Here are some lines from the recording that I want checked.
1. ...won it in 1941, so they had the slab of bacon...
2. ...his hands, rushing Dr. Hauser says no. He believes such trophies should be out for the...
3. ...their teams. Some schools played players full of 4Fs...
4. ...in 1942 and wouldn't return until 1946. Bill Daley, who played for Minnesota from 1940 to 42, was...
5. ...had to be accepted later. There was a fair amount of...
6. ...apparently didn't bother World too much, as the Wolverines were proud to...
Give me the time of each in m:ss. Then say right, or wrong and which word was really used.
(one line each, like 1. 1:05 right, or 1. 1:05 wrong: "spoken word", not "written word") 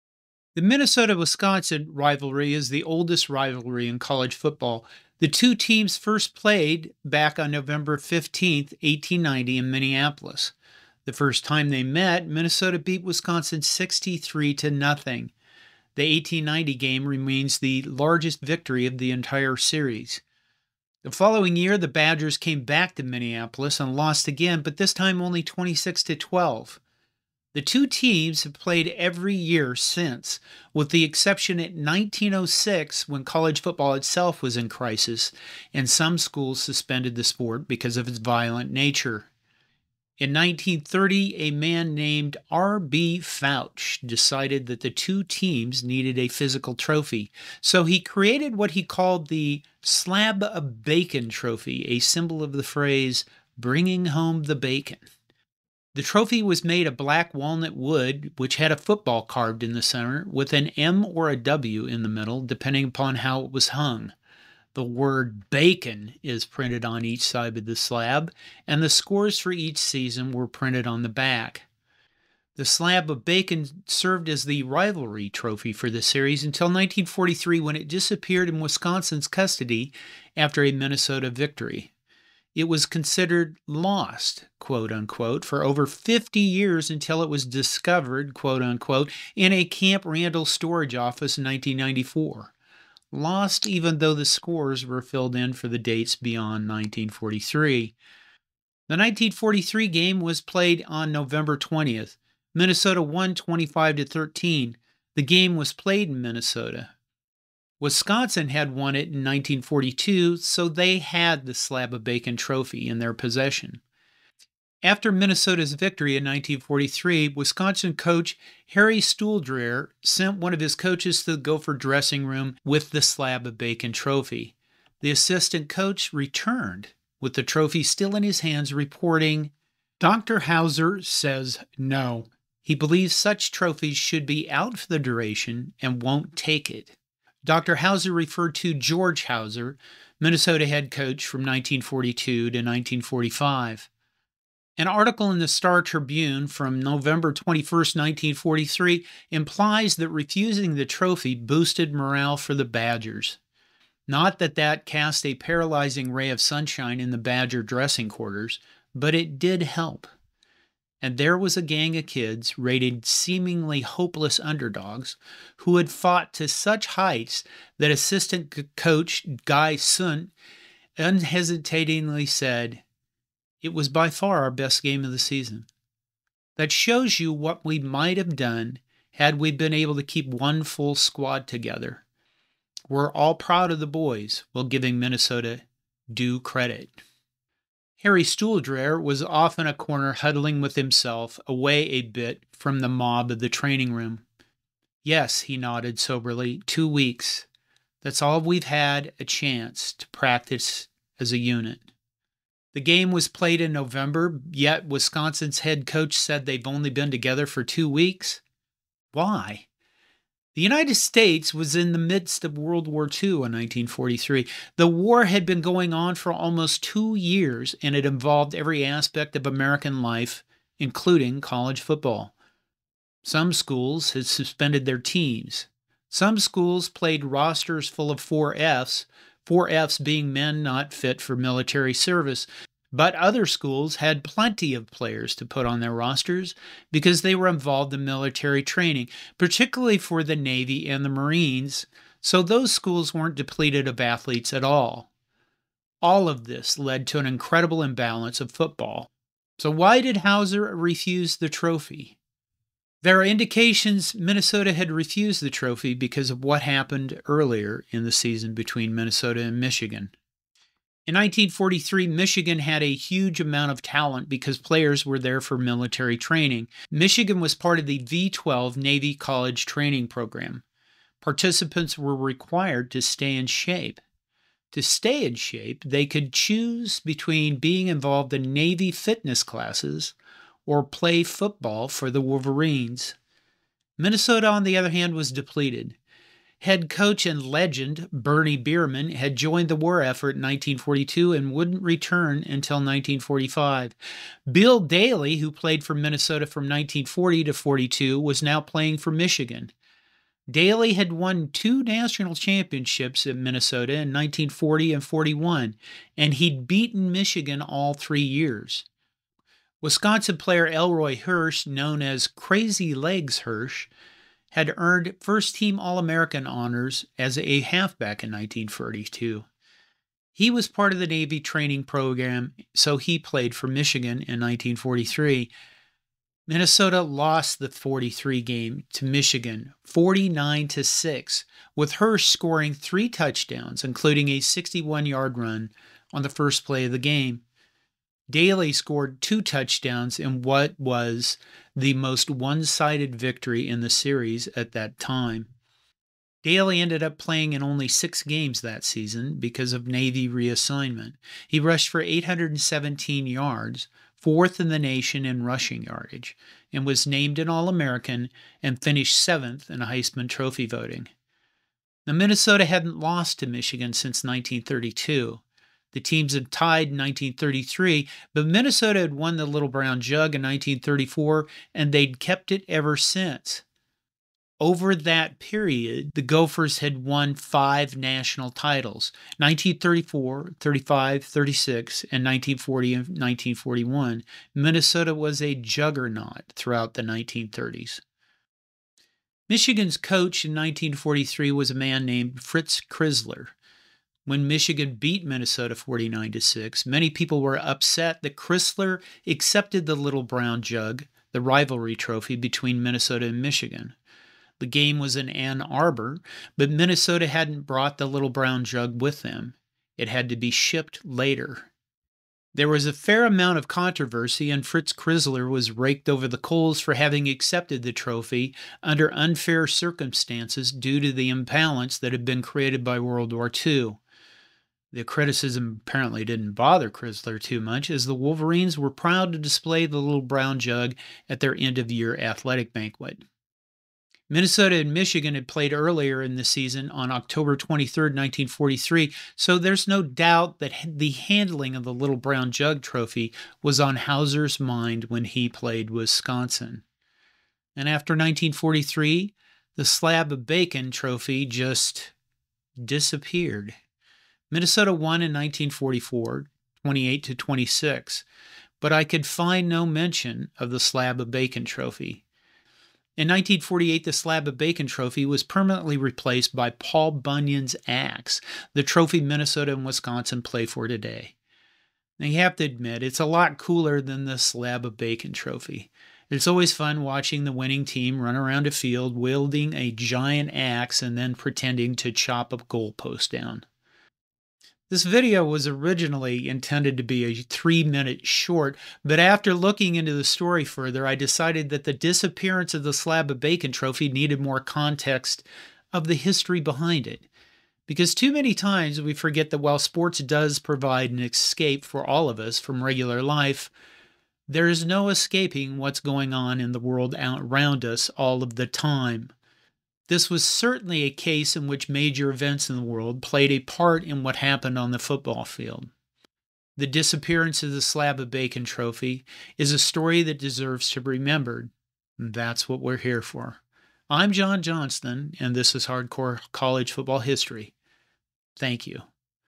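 1. 1:48 wrong: "1942", not "1941"
2. 2:08 wrong: "reporting", not "rushing"
3. 3:44 wrong: "rosters", not "players"
4. 4:50 wrong: "1945", not "1946"
5. 6:50 wrong: "shipped", not "accepted"
6. 7:05 wrong: "Crisler", not "World".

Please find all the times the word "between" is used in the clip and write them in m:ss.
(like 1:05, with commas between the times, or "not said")
4:18, 4:36, 6:42.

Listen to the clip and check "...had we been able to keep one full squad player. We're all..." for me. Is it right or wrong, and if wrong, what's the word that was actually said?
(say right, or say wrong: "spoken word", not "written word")
wrong: "together", not "player".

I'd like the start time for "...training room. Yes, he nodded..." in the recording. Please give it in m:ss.
3:13.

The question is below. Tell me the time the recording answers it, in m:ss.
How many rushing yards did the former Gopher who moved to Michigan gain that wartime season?
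5:52.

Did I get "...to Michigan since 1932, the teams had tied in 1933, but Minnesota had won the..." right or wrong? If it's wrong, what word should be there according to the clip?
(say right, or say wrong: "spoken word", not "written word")
right.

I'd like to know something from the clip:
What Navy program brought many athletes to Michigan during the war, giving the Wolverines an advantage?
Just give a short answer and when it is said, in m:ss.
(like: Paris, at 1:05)
V 12 Navy College Training Program, at 4:27.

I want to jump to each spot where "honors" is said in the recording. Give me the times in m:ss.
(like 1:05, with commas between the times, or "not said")
5:16.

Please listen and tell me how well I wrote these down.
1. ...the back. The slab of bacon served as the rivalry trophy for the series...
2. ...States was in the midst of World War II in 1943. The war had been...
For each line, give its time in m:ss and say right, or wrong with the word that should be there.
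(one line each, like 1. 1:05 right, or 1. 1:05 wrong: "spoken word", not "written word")
1. 1:11 right
2. 3:30 right.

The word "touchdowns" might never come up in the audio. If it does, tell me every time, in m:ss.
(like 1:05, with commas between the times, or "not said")
5:33, 5:39.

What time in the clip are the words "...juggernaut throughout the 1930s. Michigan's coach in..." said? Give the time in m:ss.
6:25.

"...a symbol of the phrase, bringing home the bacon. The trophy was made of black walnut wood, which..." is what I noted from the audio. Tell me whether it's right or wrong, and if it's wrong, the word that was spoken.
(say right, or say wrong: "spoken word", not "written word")
right.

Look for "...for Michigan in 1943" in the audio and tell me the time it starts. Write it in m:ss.
5:23.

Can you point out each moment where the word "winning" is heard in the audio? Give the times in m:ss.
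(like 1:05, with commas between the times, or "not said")
7:57.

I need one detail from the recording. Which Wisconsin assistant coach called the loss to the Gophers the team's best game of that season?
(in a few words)
Guy Sundt.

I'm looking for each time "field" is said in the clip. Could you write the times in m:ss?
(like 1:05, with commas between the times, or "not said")
7:58, 8:35.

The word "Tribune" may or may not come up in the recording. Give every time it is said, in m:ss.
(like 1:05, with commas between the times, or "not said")
2:25.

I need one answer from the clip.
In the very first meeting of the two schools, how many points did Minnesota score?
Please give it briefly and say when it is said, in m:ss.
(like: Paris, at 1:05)
63, at 0:13.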